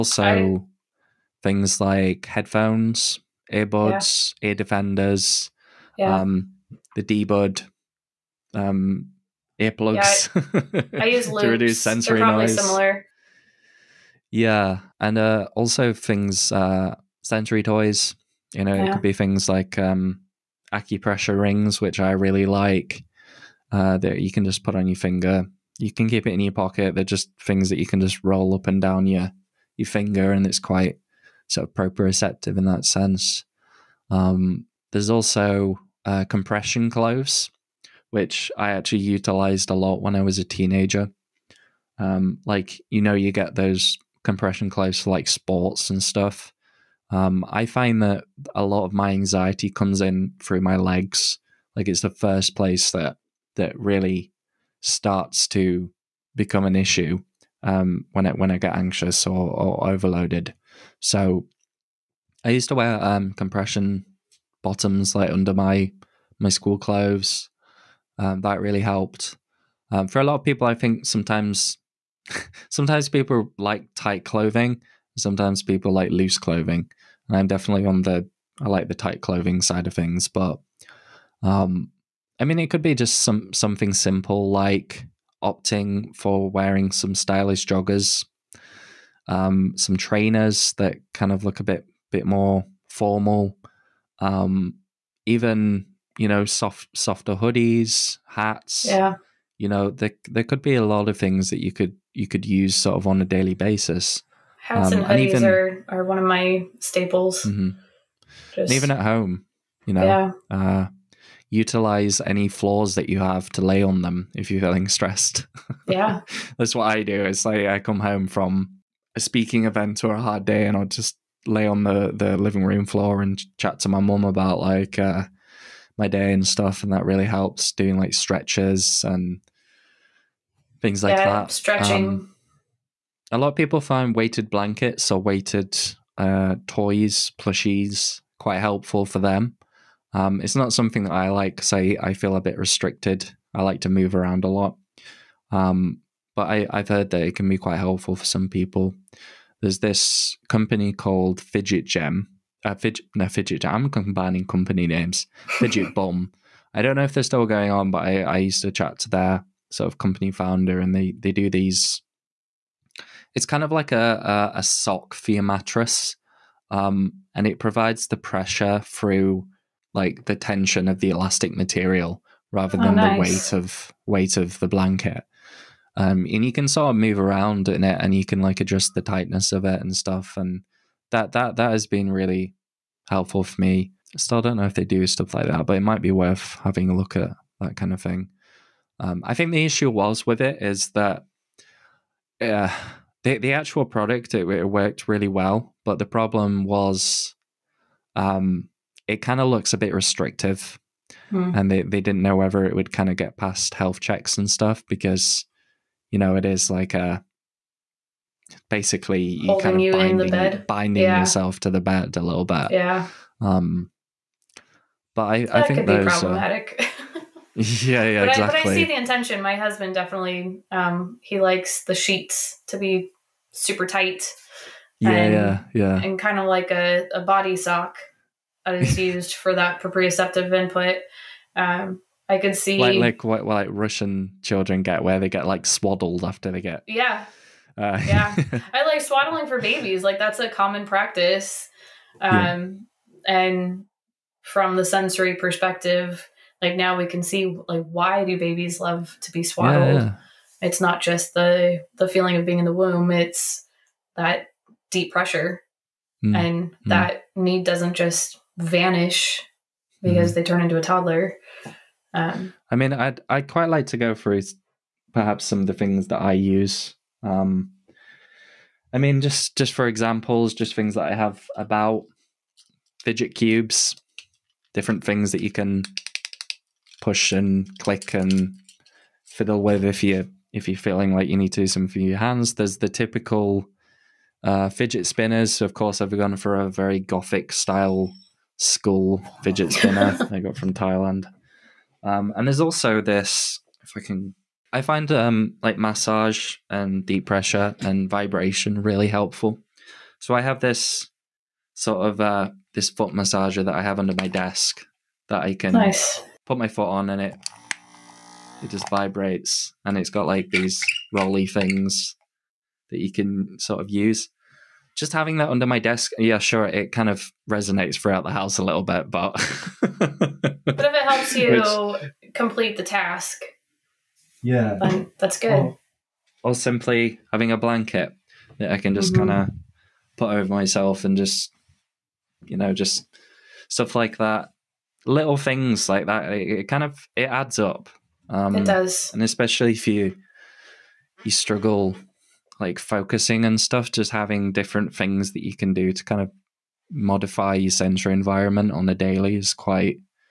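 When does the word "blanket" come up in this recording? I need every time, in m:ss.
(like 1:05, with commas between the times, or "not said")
2:14, 2:54, 5:27.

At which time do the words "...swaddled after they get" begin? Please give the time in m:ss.
3:55.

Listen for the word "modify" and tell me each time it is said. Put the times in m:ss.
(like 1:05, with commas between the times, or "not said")
5:46.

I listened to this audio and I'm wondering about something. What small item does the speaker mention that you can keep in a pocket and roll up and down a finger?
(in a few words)
acupressure rings.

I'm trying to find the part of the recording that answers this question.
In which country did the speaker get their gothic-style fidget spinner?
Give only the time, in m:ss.
4:50.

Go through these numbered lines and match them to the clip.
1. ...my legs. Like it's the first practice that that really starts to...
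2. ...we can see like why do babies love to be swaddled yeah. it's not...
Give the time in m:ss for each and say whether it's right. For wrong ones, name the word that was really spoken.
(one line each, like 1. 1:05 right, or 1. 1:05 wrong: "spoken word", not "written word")
1. 0:50 wrong: "place", not "practice"
2. 4:06 right.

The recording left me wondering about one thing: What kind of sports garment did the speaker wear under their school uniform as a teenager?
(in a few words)
compression bottoms.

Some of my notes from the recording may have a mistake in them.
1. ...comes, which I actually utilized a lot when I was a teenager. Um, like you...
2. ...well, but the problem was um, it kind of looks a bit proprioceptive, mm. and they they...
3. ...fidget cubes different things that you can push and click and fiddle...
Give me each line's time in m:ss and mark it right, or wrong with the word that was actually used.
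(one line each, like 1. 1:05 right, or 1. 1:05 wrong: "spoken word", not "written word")
1. 0:36 wrong: "clothes", not "comes"
2. 3:15 wrong: "restrictive", not "proprioceptive"
3. 4:33 right.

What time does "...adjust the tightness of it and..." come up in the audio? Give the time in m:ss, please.
2:58.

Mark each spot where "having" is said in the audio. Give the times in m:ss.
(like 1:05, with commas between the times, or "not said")
3:06, 5:15, 5:27, 5:44.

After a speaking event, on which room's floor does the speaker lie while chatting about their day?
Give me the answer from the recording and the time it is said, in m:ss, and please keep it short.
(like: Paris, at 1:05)
living room, at 2:02.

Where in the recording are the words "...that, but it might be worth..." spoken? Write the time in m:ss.
3:05.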